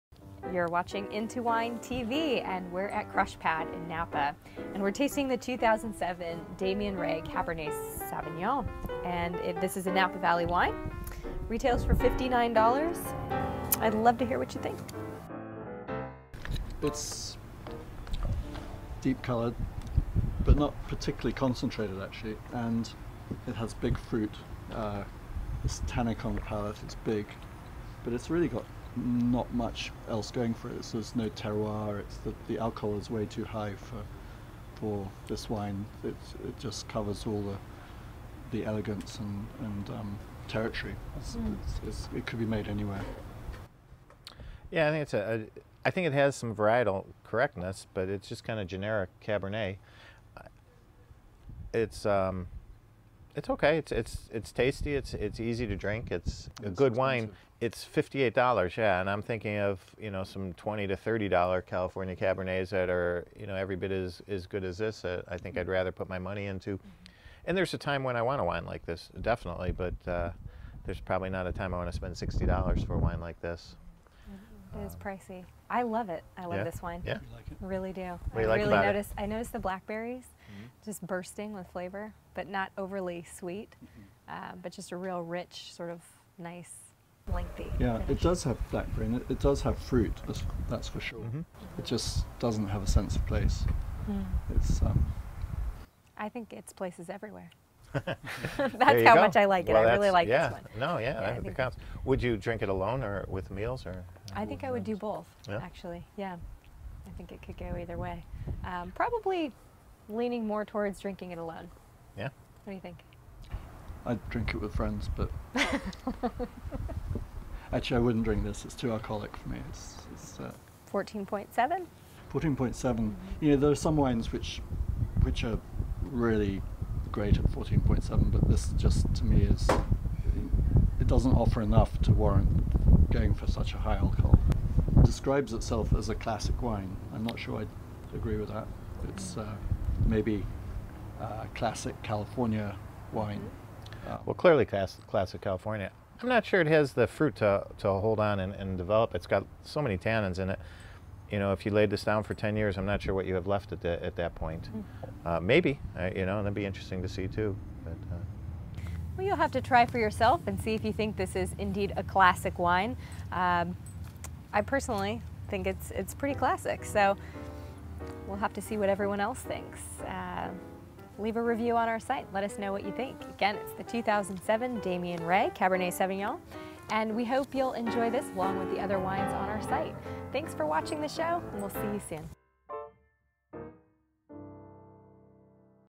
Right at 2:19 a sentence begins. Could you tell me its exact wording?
It's uh, maybe a uh, classic California wine.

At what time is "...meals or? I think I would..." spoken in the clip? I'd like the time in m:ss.
1:43.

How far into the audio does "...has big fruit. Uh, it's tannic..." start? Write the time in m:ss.
0:23.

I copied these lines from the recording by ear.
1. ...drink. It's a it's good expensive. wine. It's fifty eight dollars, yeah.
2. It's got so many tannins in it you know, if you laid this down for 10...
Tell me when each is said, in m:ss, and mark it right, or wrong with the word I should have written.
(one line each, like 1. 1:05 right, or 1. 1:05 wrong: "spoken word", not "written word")
1. 0:55 right
2. 2:29 right.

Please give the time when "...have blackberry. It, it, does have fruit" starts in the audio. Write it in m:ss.
1:28.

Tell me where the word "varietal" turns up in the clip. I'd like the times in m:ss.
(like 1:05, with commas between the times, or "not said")
0:46.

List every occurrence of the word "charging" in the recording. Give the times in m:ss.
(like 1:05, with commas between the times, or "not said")
not said.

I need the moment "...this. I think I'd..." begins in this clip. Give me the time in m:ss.
1:04.